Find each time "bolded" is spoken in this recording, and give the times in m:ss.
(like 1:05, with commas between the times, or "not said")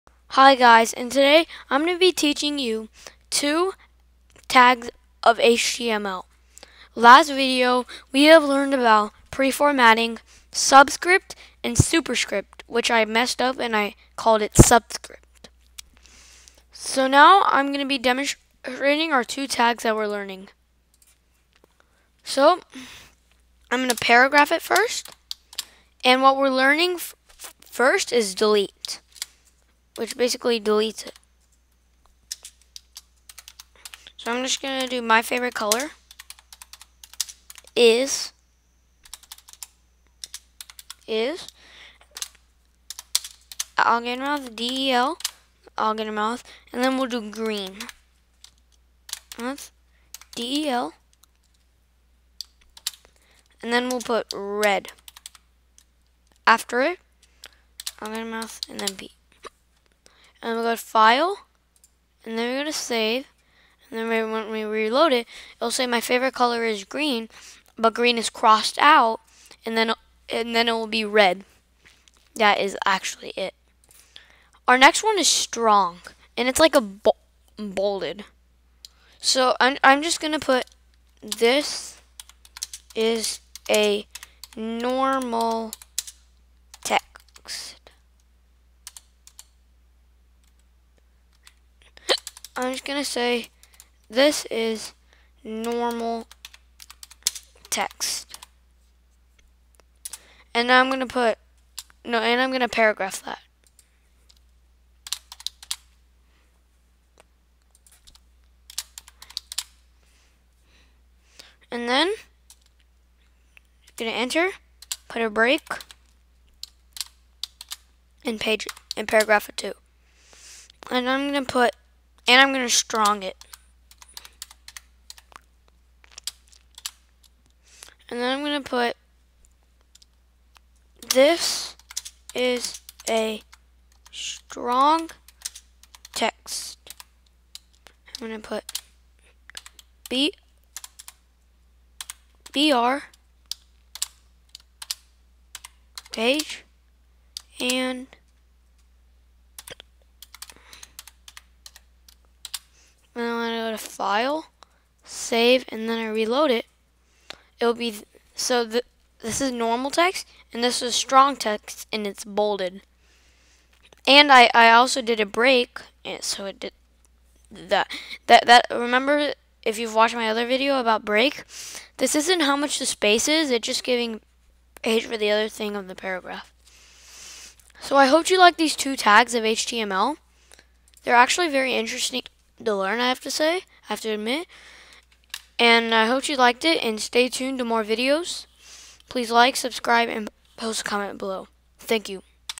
1:17, 2:42.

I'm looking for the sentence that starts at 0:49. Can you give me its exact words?
That's D-E-L, and then we'll put red.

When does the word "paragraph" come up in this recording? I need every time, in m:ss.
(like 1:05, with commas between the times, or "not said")
0:23, 1:42, 1:59, 2:55.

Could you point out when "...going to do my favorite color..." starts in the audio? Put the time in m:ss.
0:34.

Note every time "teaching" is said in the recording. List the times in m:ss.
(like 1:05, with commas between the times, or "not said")
0:02.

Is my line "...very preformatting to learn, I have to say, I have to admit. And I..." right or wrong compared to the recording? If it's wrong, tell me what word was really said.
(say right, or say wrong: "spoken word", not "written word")
wrong: "interesting", not "preformatting".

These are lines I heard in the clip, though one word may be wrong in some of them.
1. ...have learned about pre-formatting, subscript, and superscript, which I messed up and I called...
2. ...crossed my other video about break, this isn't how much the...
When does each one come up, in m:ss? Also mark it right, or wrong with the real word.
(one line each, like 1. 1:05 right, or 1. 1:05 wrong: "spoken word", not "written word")
1. 0:08 right
2. 2:49 wrong: "watched", not "crossed".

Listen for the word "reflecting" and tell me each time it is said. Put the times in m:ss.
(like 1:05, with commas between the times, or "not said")
not said.